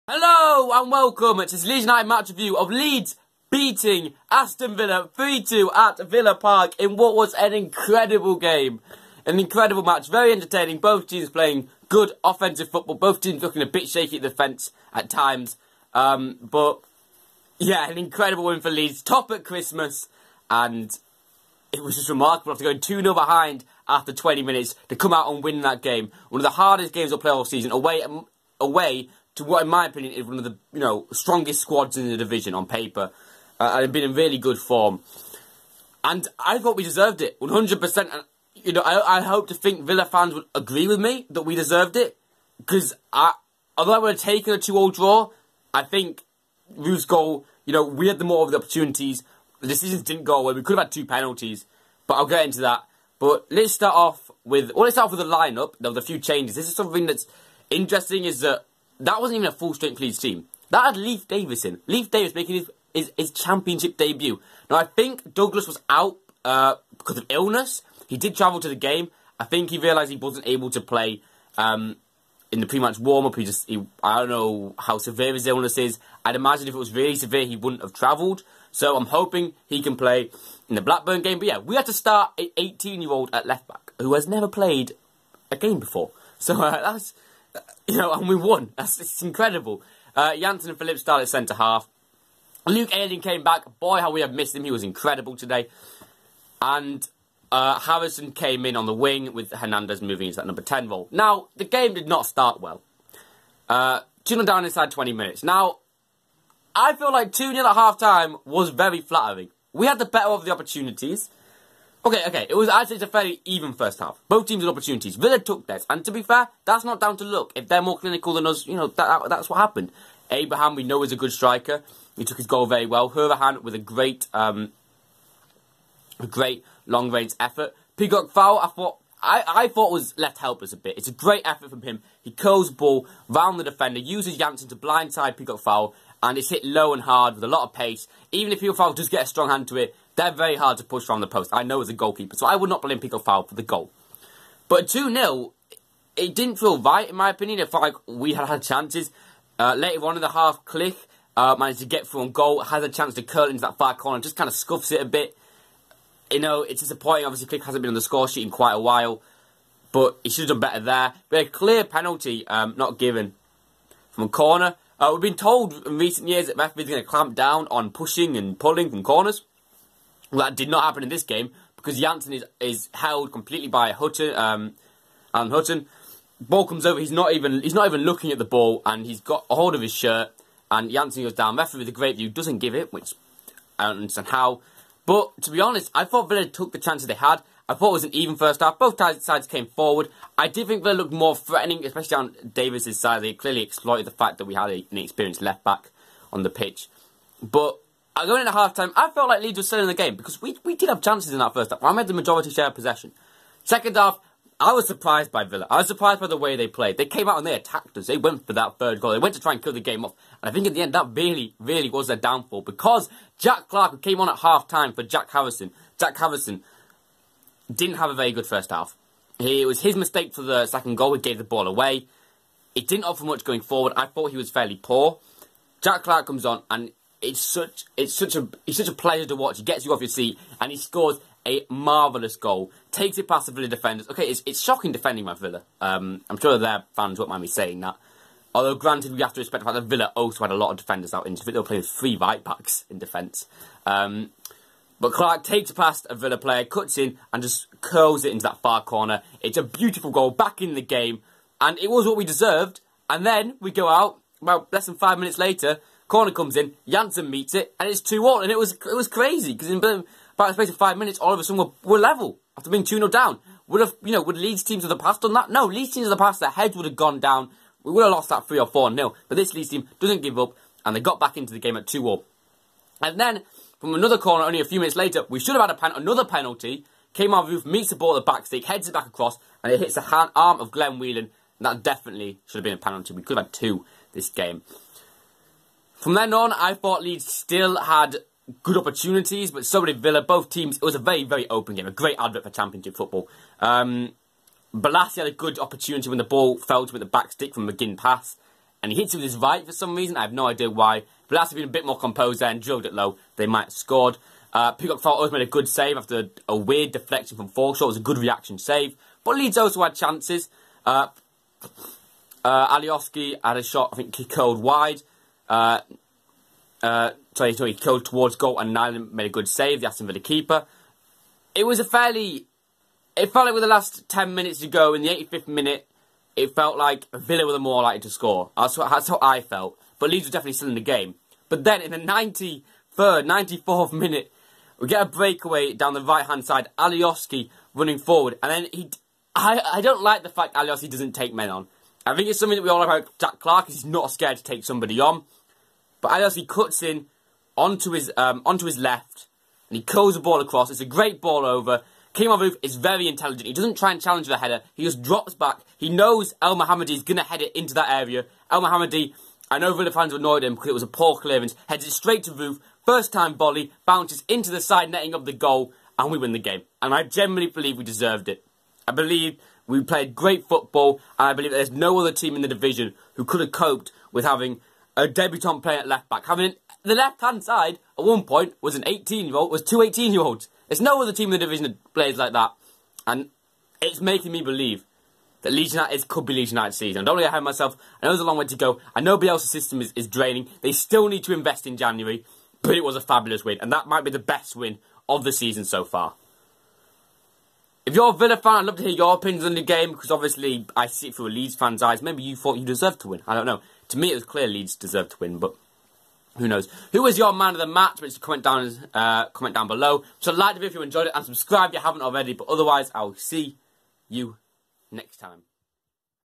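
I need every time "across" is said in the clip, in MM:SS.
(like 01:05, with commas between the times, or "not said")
04:39, 05:50.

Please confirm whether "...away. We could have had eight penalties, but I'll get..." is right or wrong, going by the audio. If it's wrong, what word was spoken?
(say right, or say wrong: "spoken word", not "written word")
wrong: "two", not "eight".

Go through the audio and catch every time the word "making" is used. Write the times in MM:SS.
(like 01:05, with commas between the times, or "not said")
01:02, 06:24.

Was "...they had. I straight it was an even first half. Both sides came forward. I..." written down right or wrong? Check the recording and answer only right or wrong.
wrong.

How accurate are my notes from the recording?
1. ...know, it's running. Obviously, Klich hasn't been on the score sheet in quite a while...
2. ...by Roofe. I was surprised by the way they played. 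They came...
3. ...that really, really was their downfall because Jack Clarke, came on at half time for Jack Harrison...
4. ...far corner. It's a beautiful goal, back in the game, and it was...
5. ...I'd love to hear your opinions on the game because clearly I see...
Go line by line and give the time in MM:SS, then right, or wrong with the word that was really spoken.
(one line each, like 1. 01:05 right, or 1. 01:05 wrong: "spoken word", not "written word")
1. 02:36 wrong: "disappointing", not "running"
2. 03:25 wrong: "Villa", not "Roofe"
3. 03:30 right
4. 04:08 right
5. 06:38 wrong: "obviously", not "clearly".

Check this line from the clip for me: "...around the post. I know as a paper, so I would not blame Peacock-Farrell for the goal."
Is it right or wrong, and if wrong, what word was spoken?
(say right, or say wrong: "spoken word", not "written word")
wrong: "goalkeeper", not "paper".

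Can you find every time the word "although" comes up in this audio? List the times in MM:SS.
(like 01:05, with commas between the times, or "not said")
00:43, 03:58.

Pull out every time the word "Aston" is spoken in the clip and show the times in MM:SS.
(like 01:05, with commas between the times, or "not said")
00:04, 05:19.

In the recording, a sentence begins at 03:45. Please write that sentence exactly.
Jack Clarke comes on and it's such it's such a it's such a pleasure to watch.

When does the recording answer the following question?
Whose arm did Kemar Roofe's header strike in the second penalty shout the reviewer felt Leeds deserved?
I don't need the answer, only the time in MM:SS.
04:40.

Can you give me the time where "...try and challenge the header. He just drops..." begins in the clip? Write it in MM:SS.
05:53.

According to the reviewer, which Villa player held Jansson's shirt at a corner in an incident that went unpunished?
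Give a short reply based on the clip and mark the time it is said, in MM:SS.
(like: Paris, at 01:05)
Alan Hutton, at 02:55.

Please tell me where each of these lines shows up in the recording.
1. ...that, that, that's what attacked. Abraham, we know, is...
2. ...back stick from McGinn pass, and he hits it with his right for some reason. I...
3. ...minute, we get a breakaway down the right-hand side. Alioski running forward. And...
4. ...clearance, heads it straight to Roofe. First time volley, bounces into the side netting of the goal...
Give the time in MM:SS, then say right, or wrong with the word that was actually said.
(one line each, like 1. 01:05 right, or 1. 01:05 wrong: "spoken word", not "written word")
1. 01:58 wrong: "happened", not "attacked"
2. 04:57 right
3. 05:33 right
4. 06:01 right.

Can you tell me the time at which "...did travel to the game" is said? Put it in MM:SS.
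01:08.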